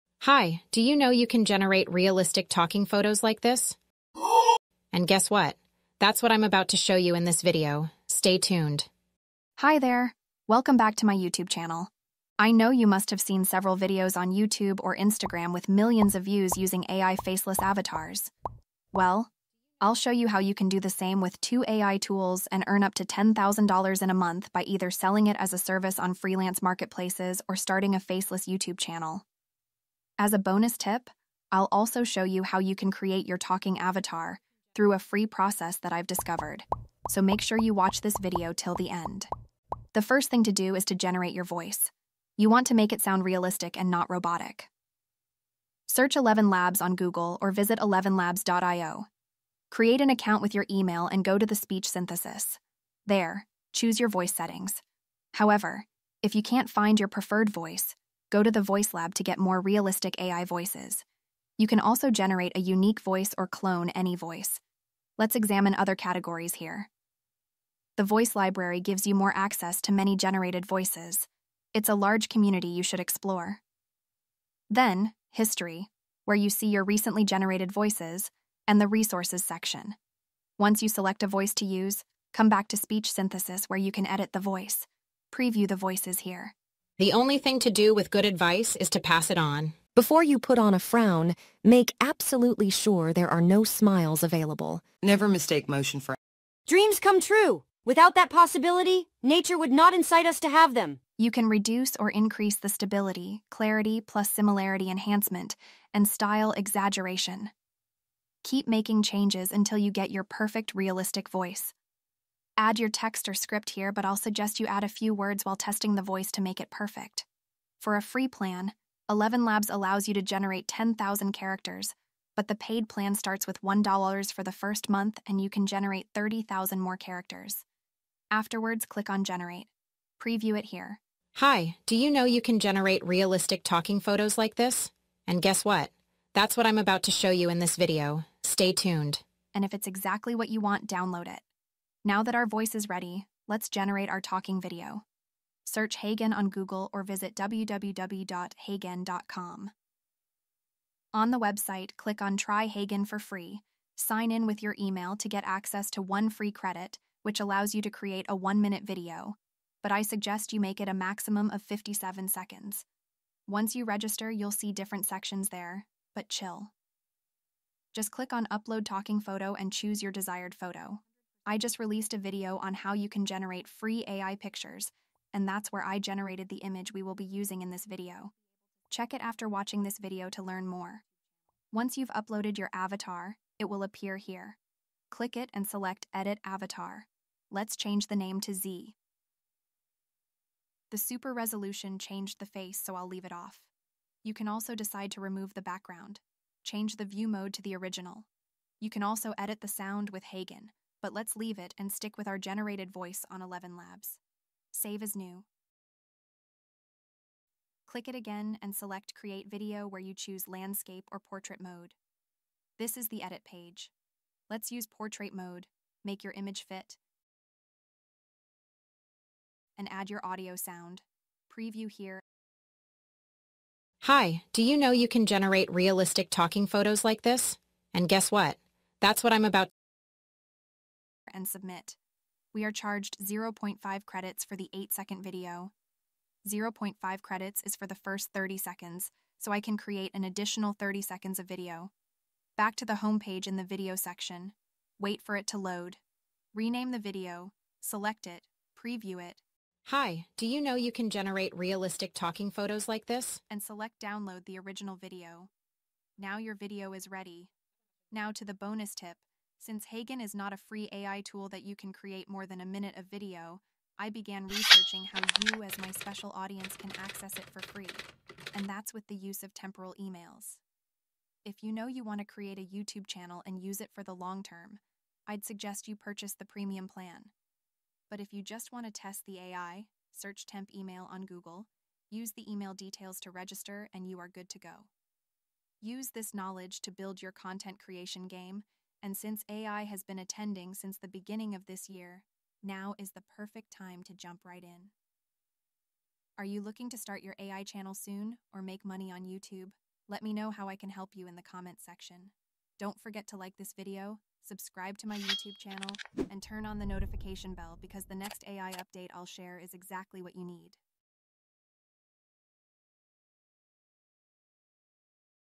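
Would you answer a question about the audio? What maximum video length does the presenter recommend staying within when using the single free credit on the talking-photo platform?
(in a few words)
57 seconds.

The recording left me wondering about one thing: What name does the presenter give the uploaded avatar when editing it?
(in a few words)
Z.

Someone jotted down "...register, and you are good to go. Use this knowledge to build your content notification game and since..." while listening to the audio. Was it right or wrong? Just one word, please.
wrong.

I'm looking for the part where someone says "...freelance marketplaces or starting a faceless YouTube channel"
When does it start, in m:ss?
0:26.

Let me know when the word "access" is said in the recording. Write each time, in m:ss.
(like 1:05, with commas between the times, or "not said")
1:09, 2:35, 4:26.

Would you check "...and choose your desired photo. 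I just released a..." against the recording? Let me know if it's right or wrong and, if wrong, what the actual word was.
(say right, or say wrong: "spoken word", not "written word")
right.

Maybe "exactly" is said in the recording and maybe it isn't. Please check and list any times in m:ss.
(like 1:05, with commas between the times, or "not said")
2:19, 5:09.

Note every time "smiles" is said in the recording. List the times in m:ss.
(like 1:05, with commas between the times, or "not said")
1:33.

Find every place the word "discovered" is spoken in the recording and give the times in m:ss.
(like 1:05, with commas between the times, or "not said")
0:36.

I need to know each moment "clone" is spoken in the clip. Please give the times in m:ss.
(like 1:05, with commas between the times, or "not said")
1:03.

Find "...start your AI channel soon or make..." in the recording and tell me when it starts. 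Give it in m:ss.
4:56.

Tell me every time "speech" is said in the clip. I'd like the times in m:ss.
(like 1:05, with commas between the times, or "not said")
0:51, 1:22.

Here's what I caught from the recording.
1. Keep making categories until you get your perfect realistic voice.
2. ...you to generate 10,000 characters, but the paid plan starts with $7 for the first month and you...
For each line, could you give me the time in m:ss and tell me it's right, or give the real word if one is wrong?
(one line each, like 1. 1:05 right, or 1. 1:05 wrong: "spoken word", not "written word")
1. 1:48 wrong: "changes", not "categories"
2. 2:00 wrong: "1", not "7".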